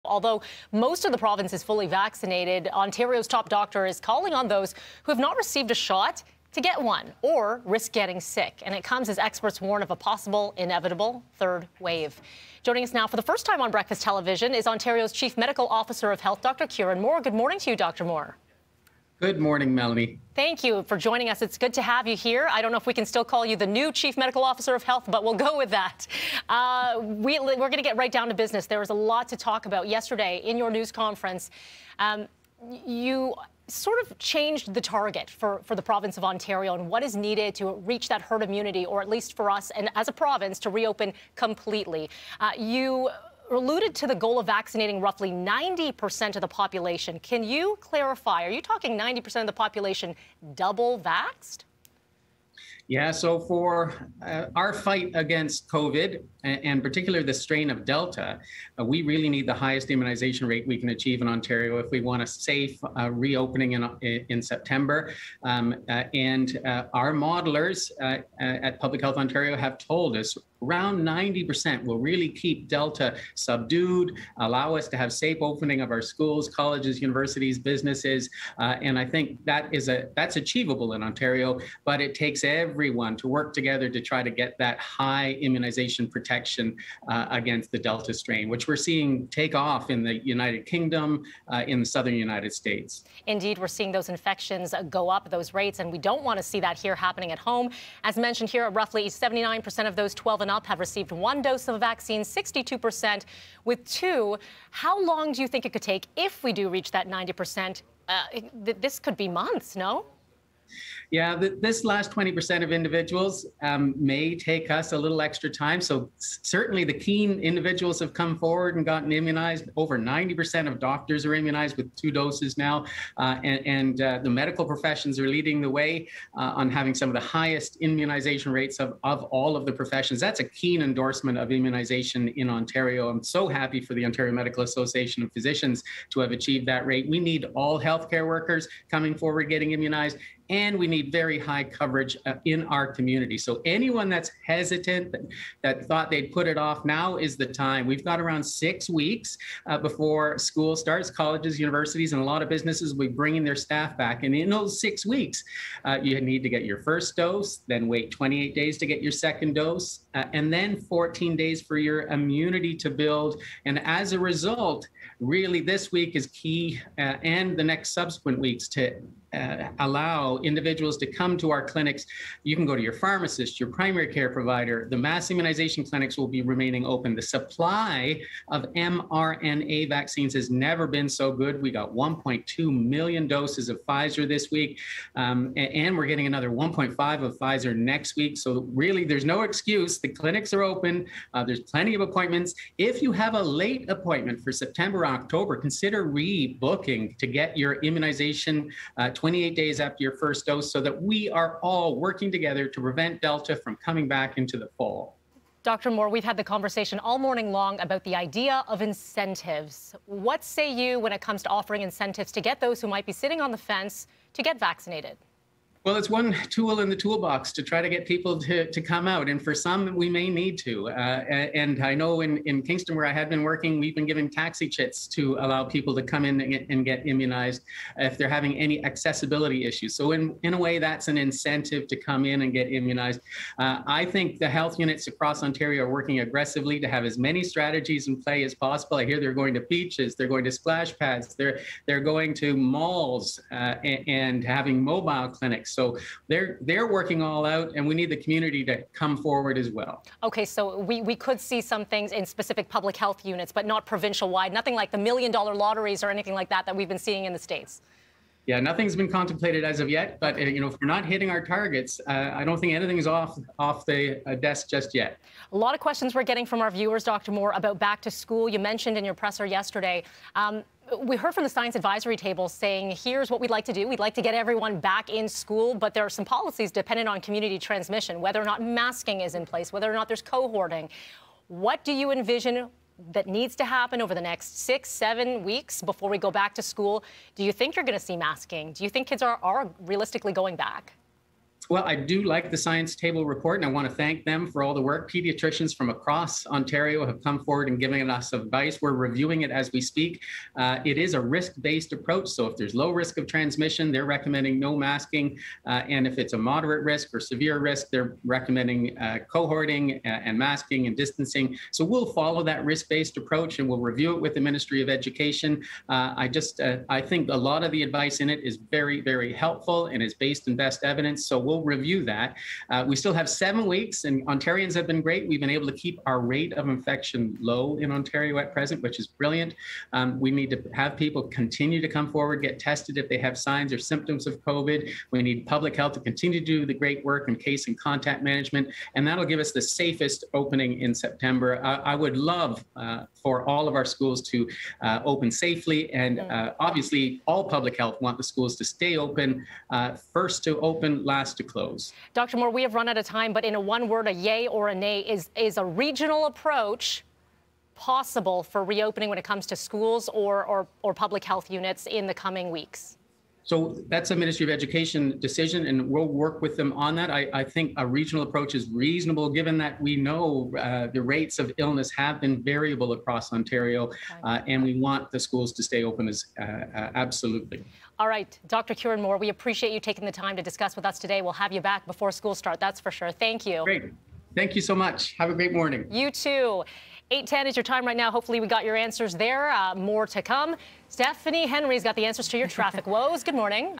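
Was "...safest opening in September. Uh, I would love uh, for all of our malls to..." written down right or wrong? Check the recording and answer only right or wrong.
wrong.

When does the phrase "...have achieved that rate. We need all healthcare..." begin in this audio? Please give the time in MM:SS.
02:16.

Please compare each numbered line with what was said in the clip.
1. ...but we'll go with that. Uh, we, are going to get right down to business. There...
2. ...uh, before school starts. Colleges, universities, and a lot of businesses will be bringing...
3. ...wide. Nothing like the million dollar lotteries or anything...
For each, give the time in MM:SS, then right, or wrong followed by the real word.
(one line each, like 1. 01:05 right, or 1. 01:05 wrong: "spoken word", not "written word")
1. 00:25 right
2. 02:29 right
3. 04:14 right.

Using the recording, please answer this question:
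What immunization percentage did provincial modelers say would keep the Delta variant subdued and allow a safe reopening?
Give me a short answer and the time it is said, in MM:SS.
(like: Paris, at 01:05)
90%, at 01:10.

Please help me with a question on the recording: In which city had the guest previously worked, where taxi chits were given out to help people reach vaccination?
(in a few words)
Kingston.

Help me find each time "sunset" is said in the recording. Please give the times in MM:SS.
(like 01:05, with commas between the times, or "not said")
not said.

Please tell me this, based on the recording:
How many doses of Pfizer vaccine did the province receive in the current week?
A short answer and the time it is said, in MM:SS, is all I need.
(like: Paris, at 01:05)
1.2 million, at 03:01.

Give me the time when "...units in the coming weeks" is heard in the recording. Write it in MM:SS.
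06:01.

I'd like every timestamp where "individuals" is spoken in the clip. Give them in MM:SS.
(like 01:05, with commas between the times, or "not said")
01:52, 01:57, 02:50.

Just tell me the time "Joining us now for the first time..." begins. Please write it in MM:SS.
00:12.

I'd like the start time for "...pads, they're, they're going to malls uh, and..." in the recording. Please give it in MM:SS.
04:00.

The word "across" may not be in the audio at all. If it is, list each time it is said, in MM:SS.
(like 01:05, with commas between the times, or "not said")
03:55, 04:55, 06:12.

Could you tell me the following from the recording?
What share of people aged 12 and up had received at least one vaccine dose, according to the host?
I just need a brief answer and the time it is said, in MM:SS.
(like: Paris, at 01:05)
79%, at 01:39.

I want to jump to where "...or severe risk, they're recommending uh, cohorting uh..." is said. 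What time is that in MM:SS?
05:07.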